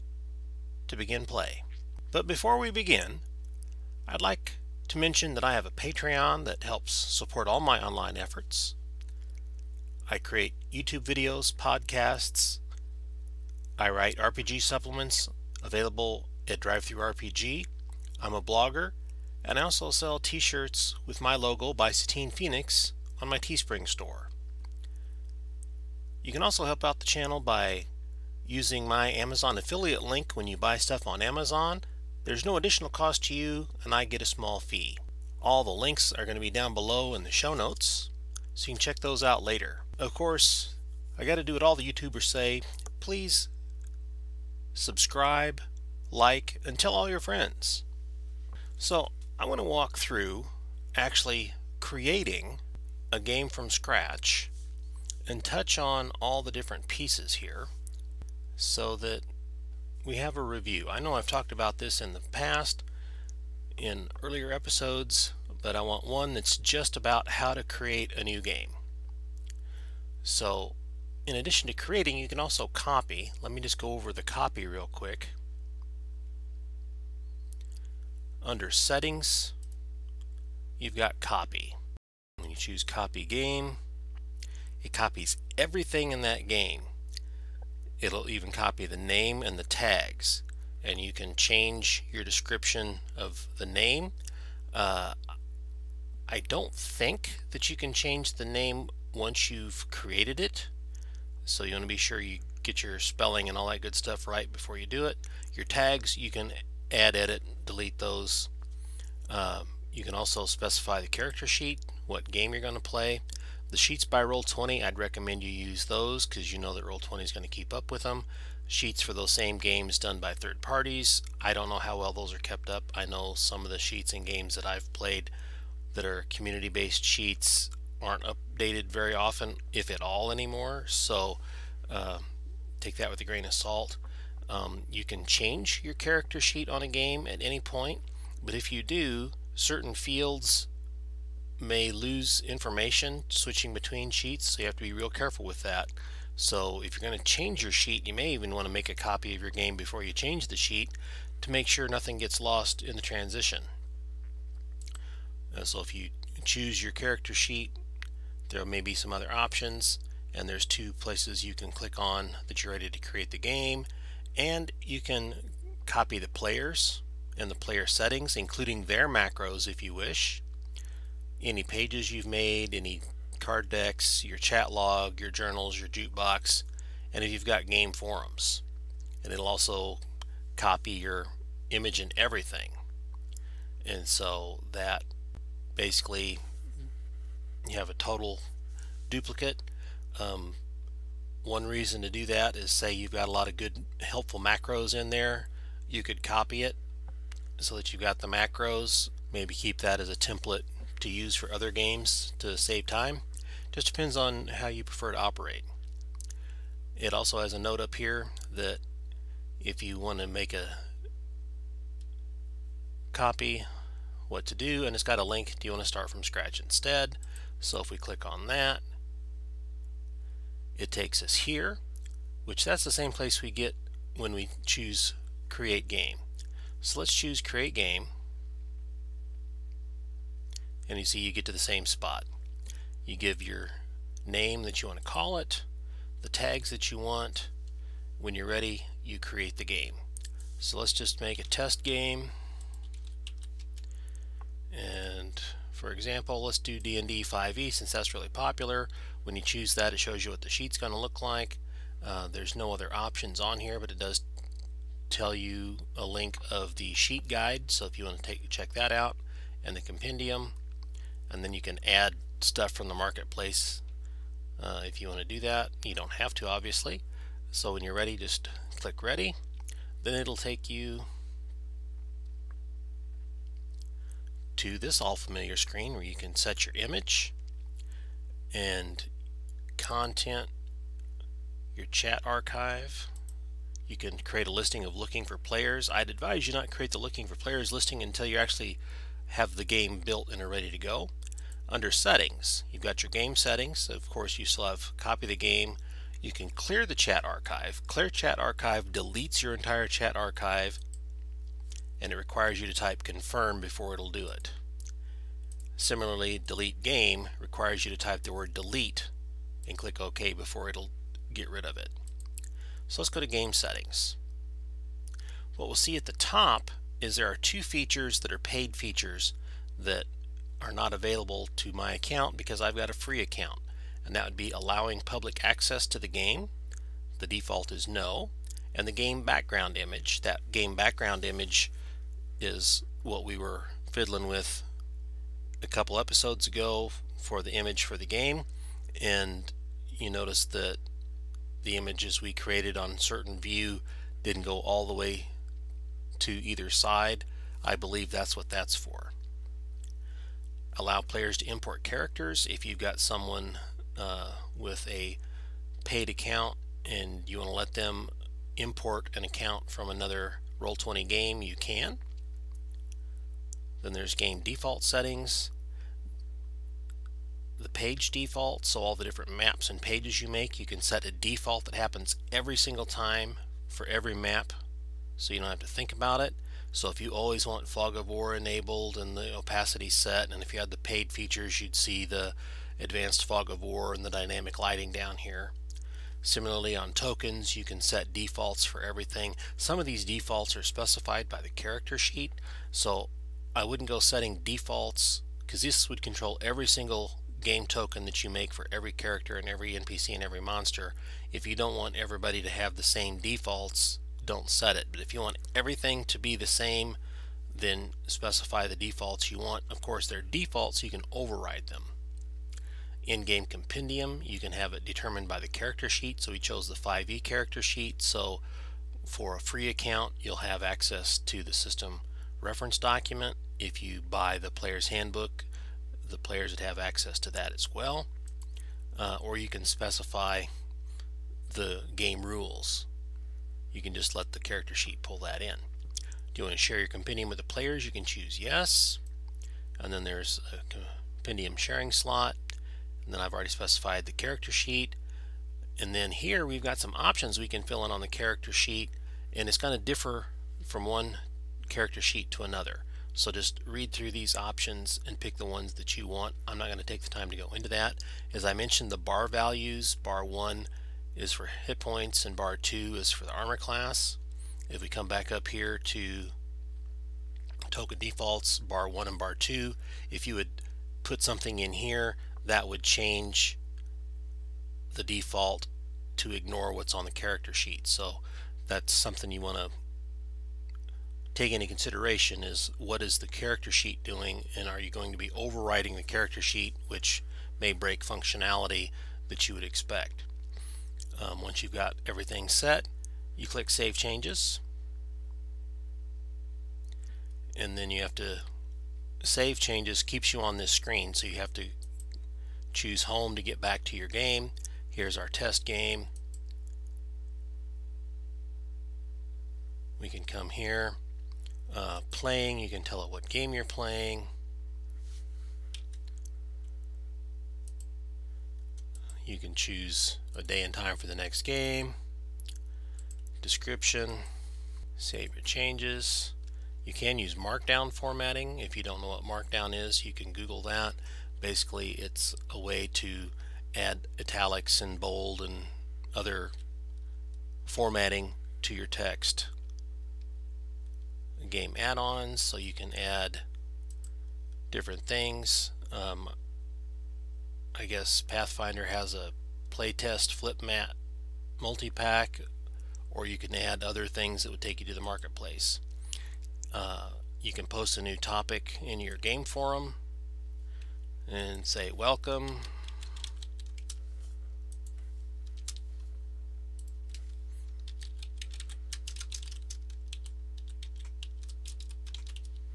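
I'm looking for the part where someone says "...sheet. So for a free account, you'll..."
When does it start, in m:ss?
6:57.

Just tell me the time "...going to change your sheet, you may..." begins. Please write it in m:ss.
2:27.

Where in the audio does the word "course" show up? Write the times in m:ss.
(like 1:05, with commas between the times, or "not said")
0:40, 4:54, 6:49.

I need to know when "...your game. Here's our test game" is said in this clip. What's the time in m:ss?
8:23.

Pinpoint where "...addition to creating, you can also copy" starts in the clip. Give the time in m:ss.
1:11.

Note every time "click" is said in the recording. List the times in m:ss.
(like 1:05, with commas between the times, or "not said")
2:41, 3:37, 4:28, 5:09, 8:13.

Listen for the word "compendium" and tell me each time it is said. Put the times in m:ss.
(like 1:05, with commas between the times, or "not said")
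4:19, 6:53, 7:16, 7:21.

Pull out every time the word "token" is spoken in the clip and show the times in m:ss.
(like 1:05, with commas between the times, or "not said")
6:26, 6:37, 7:47.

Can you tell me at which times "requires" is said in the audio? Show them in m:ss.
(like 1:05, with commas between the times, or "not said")
5:02, 5:07.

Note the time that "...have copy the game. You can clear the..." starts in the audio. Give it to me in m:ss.
4:54.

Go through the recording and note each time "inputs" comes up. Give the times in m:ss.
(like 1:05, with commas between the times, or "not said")
not said.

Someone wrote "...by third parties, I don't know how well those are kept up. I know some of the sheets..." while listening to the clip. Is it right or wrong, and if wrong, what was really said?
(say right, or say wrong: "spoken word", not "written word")
right.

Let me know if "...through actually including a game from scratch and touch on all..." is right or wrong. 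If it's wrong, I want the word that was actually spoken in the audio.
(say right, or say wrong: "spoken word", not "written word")
wrong: "creating", not "including".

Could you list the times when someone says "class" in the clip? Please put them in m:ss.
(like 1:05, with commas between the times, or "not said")
7:43.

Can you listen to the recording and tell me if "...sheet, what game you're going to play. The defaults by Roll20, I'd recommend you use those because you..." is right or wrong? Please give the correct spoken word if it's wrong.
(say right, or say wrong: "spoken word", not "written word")
wrong: "sheets", not "defaults".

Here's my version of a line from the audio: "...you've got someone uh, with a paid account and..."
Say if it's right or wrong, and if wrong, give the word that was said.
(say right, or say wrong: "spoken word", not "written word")
right.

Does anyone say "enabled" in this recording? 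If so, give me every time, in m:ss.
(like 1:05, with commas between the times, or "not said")
6:18.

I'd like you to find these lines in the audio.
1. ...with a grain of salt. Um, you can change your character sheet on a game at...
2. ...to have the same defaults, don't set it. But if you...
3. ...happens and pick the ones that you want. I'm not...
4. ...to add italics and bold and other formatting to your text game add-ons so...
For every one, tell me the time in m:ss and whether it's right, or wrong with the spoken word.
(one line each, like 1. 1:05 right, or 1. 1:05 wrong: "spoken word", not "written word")
1. 2:13 right
2. 6:42 right
3. 7:34 wrong: "options", not "happens"
4. 8:52 right.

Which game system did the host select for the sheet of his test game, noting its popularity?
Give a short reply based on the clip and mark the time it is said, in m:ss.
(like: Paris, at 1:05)
D&D 5e, at 4:06.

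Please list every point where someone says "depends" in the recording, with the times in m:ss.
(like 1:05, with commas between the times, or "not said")
3:23.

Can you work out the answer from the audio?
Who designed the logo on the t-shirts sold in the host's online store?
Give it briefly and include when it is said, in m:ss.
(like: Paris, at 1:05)
Satine Phoenix, at 0:21.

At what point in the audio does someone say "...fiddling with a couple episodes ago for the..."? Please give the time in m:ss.
5:33.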